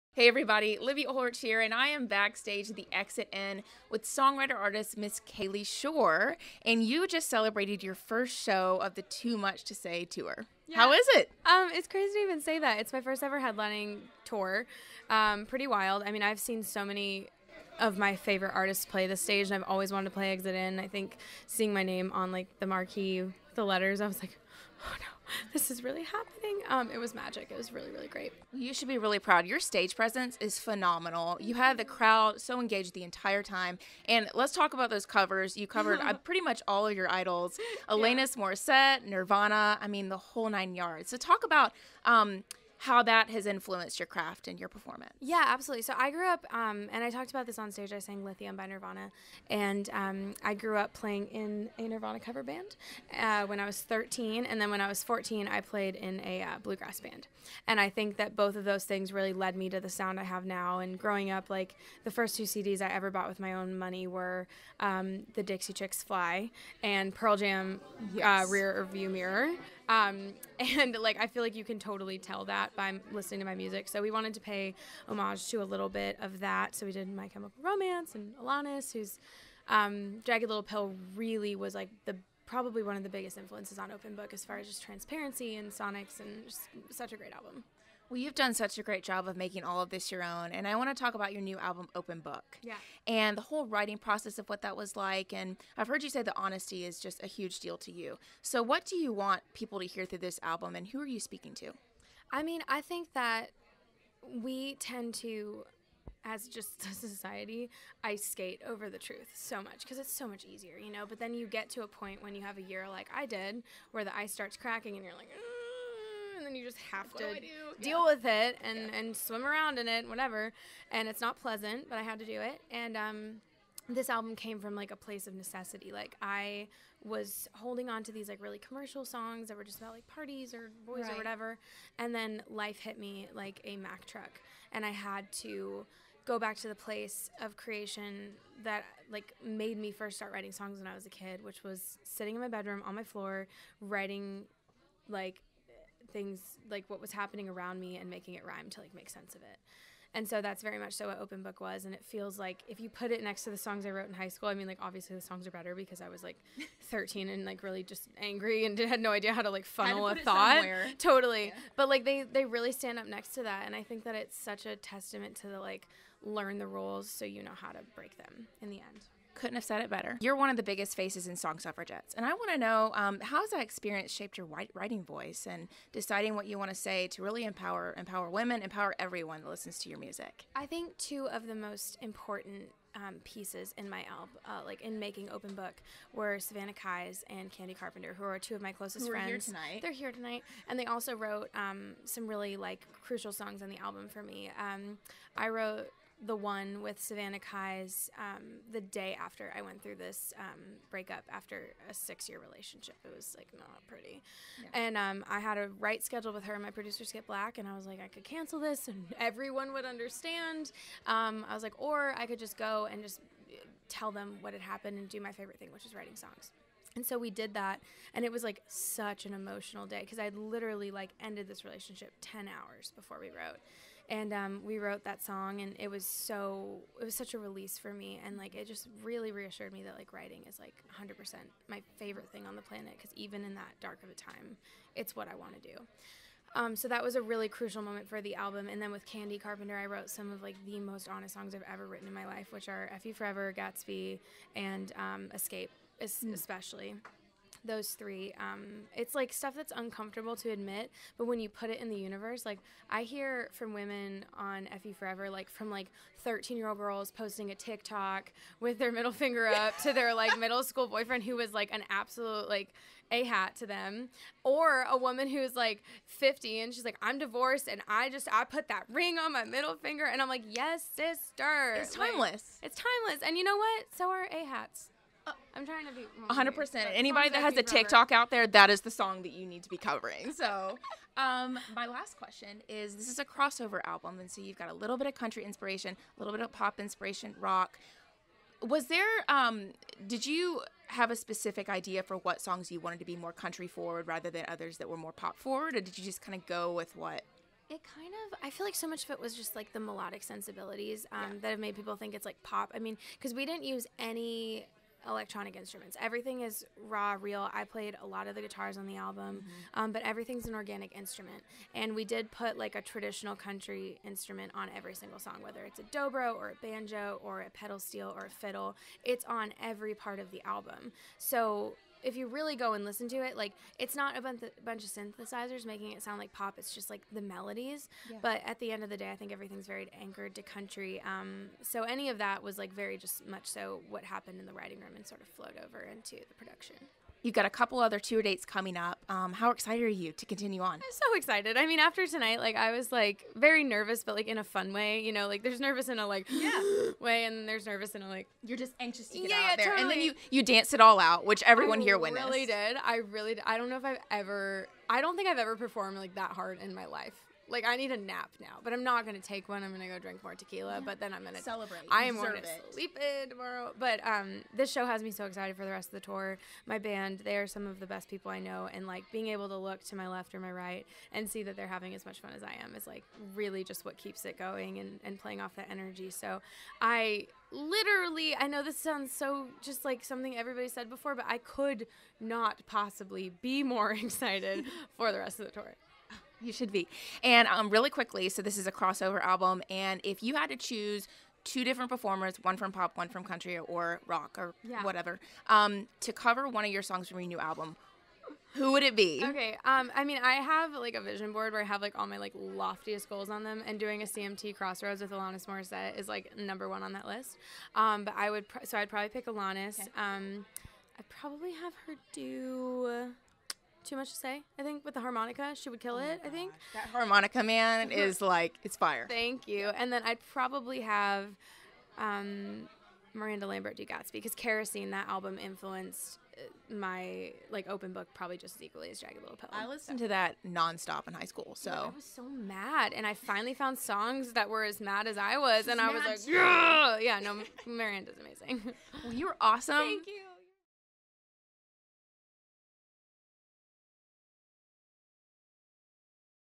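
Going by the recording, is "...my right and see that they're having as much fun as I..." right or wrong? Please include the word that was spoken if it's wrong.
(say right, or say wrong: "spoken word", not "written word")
right.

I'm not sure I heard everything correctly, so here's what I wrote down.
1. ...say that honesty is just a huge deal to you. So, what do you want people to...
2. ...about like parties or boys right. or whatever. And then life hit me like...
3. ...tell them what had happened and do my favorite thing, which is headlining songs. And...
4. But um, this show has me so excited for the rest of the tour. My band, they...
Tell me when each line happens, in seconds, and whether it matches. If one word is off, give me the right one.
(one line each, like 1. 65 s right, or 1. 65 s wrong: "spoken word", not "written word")
1. 96 s right
2. 129 s right
3. 213 s wrong: "writing", not "headlining"
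4. 363 s right.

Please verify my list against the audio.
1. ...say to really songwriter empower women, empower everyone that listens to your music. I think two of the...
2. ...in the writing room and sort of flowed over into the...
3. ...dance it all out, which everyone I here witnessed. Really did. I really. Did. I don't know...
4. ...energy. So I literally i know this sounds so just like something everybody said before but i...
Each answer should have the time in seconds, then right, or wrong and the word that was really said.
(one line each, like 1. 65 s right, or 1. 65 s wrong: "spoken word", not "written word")
1. 176 s wrong: "empower", not "songwriter"
2. 334 s right
3. 350 s right
4. 375 s right.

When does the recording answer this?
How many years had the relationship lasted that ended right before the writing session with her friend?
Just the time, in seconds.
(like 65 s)
201 s.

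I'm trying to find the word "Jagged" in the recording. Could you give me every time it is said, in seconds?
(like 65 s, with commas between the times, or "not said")
80 s, 428 s.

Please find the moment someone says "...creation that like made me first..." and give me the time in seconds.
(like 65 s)
137 s.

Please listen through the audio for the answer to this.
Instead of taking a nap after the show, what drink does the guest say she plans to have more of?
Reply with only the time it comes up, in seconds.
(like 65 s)
360 s.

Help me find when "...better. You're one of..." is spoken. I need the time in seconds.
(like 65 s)
169 s.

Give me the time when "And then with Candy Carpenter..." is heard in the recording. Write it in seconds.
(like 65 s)
238 s.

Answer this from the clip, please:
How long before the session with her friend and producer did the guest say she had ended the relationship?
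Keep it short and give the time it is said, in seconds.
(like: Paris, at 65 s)
10 hours, at 222 s.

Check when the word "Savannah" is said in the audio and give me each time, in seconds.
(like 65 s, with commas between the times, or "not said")
186 s, 197 s.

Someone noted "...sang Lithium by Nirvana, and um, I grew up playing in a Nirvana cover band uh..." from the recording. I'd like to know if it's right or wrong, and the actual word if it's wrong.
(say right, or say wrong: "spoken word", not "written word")
right.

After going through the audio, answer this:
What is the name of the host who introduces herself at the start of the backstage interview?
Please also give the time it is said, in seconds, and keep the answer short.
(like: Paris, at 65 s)
Livy O'Hort, at 0 s.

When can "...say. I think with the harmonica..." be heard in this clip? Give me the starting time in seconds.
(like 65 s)
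414 s.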